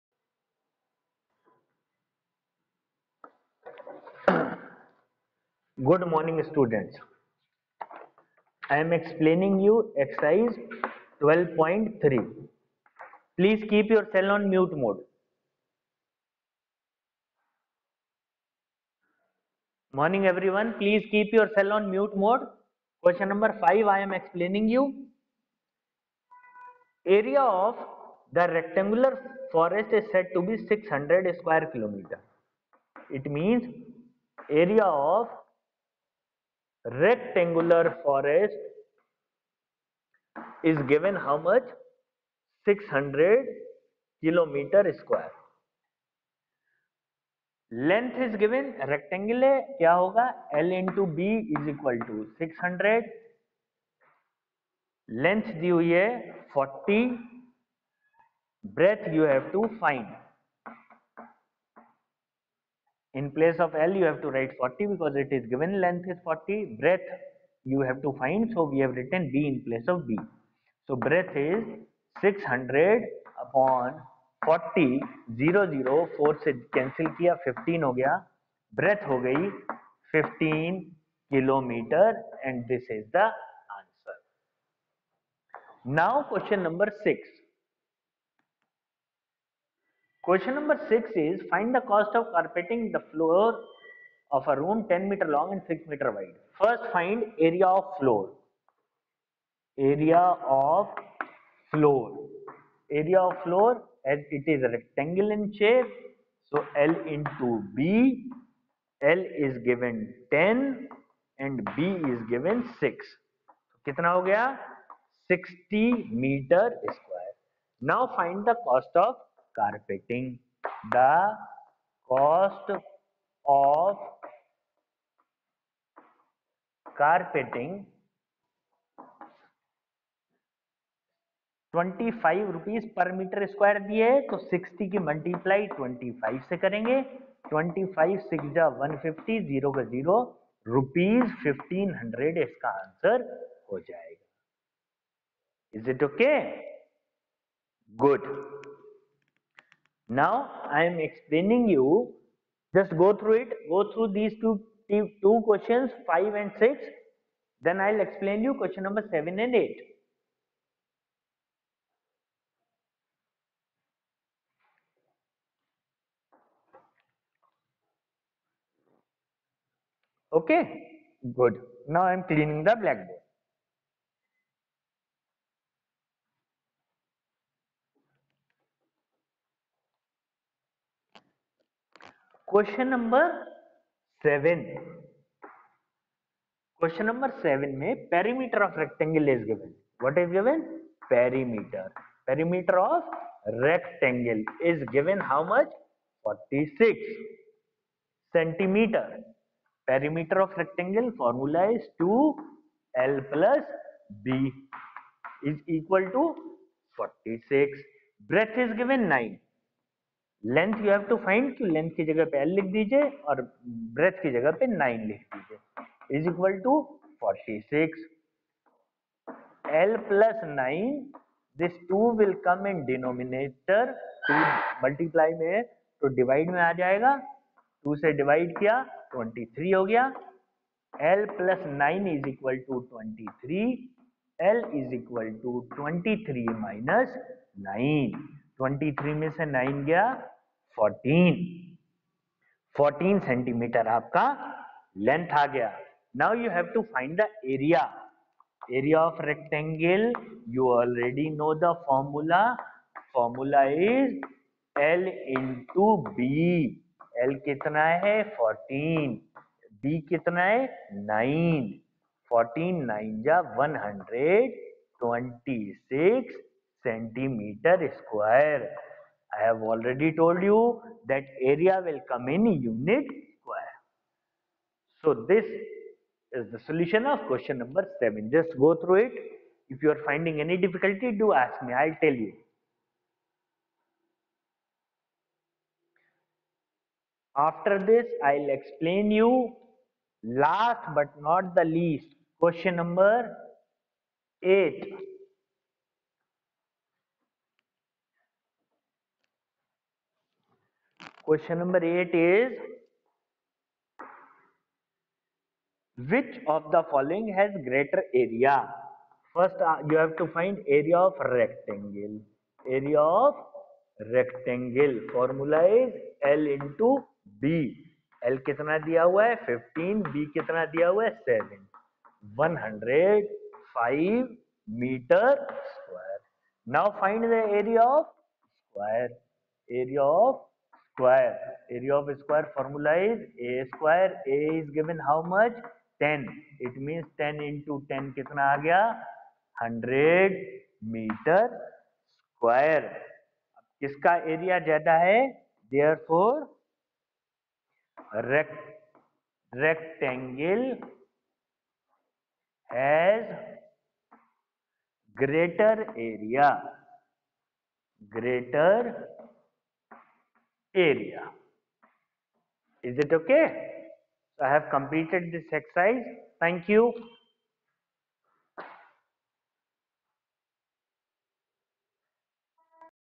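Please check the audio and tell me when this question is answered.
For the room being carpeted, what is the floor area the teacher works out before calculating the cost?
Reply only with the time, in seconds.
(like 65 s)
115 s.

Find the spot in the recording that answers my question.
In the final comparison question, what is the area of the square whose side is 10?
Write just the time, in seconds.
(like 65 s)
339 s.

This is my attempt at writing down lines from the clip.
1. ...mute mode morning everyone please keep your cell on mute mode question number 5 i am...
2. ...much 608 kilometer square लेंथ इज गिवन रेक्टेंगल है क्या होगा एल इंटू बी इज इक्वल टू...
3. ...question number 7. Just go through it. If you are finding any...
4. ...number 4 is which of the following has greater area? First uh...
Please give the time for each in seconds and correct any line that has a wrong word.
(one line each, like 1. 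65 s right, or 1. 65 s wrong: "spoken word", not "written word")
1. 14 s right
2. 41 s wrong: "600", not "608"
3. 277 s right
4. 301 s wrong: "8", not "4".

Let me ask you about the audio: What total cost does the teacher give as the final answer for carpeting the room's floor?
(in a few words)
1500 rupees.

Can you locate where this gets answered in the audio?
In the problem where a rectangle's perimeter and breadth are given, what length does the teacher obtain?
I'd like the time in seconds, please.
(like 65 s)
242 s.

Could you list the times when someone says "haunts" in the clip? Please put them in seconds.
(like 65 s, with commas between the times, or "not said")
not said.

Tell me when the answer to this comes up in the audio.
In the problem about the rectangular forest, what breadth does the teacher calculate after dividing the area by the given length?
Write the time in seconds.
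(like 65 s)
80 s.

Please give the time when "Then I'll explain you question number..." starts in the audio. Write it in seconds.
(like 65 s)
157 s.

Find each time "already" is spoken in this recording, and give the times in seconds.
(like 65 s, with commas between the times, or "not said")
269 s.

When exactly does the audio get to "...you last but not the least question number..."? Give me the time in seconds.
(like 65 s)
289 s.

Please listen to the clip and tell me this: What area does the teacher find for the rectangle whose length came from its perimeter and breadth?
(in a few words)
126 square centimeters.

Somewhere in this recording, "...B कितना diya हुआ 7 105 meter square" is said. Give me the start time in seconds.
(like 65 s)
320 s.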